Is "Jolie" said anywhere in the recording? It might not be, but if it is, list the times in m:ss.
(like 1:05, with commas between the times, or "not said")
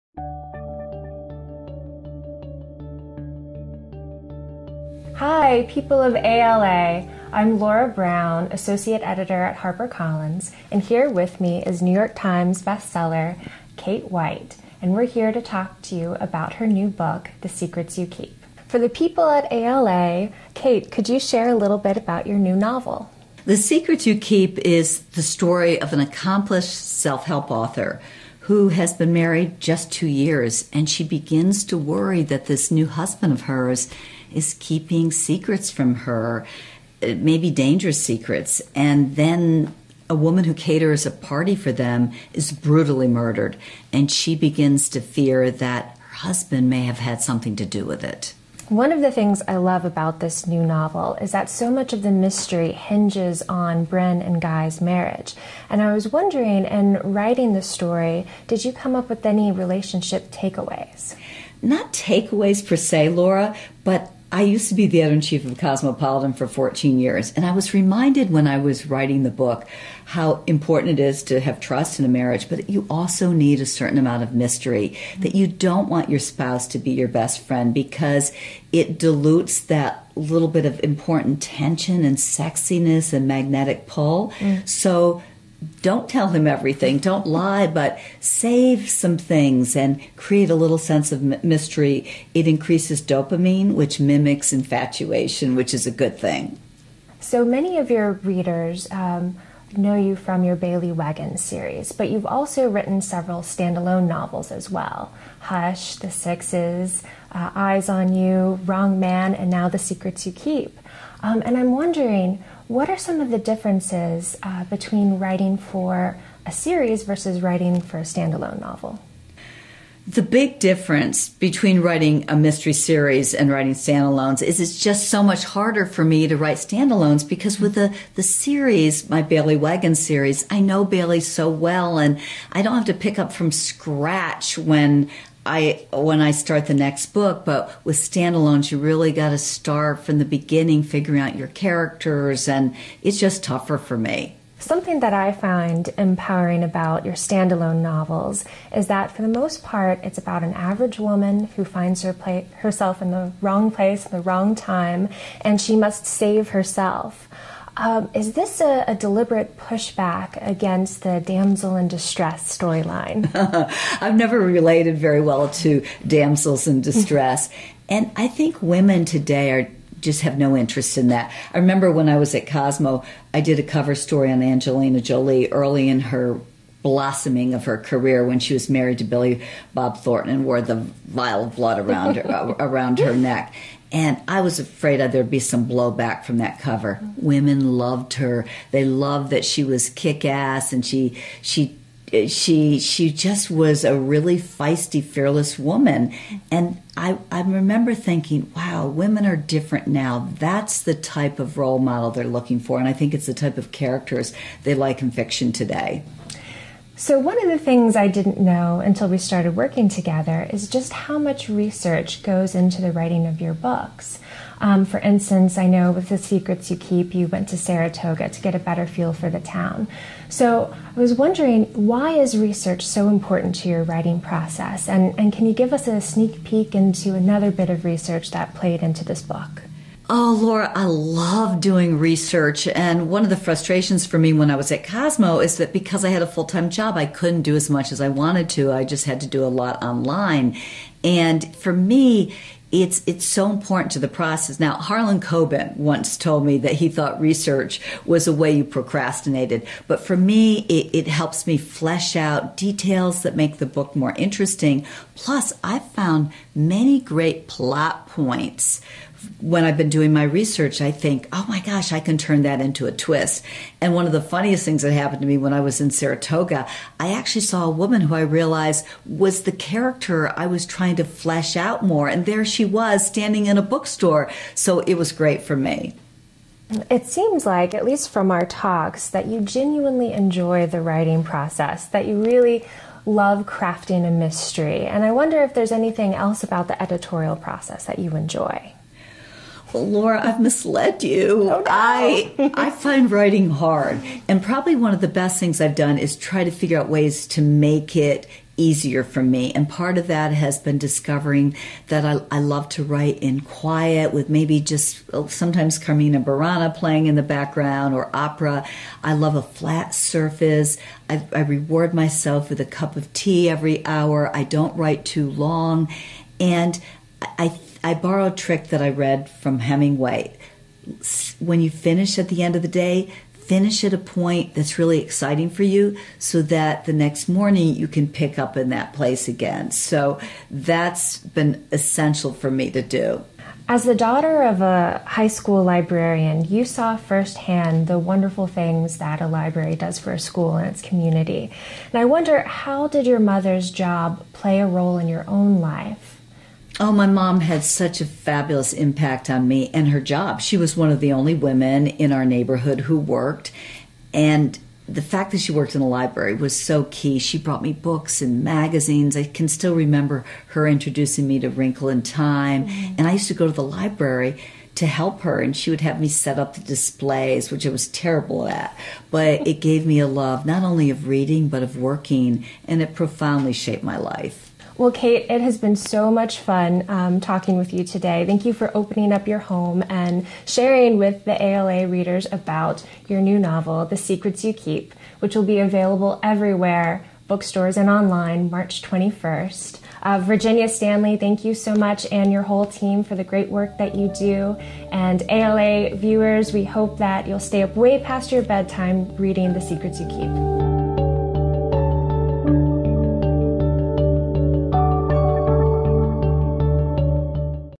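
2:54.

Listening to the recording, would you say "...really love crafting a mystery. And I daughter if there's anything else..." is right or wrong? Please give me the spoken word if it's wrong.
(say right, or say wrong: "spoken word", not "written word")
wrong: "wonder", not "daughter".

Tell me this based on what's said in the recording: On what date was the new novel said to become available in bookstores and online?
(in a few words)
March 21.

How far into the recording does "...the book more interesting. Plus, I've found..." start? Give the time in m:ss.
4:13.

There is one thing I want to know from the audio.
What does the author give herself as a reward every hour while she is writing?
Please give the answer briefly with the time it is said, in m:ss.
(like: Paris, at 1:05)
A cup of tea, at 5:12.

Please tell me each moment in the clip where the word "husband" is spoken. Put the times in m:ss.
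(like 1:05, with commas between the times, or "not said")
0:32, 0:46.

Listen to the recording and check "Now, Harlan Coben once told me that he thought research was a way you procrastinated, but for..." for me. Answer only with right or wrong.
right.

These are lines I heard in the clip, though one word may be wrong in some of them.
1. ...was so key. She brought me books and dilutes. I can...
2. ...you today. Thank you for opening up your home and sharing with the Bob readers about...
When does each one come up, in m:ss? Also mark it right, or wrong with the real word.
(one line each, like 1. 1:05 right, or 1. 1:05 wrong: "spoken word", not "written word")
1. 5:56 wrong: "magazines", not "dilutes"
2. 6:17 wrong: "ALA", not "Bob".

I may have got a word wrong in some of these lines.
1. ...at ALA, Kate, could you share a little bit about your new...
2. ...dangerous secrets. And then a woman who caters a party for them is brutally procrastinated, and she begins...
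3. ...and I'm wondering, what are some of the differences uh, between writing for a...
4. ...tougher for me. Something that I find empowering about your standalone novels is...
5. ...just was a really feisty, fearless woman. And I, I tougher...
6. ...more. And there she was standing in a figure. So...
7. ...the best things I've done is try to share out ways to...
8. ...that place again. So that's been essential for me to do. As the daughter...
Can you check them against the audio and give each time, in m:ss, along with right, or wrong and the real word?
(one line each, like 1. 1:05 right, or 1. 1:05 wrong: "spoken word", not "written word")
1. 0:19 right
2. 0:37 wrong: "murdered", not "procrastinated"
3. 1:51 right
4. 2:23 right
5. 3:13 wrong: "remember", not "tougher"
6. 4:31 wrong: "bookstore", not "figure"
7. 4:54 wrong: "figure", not "share"
8. 5:28 right.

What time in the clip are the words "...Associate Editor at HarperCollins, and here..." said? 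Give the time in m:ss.
0:08.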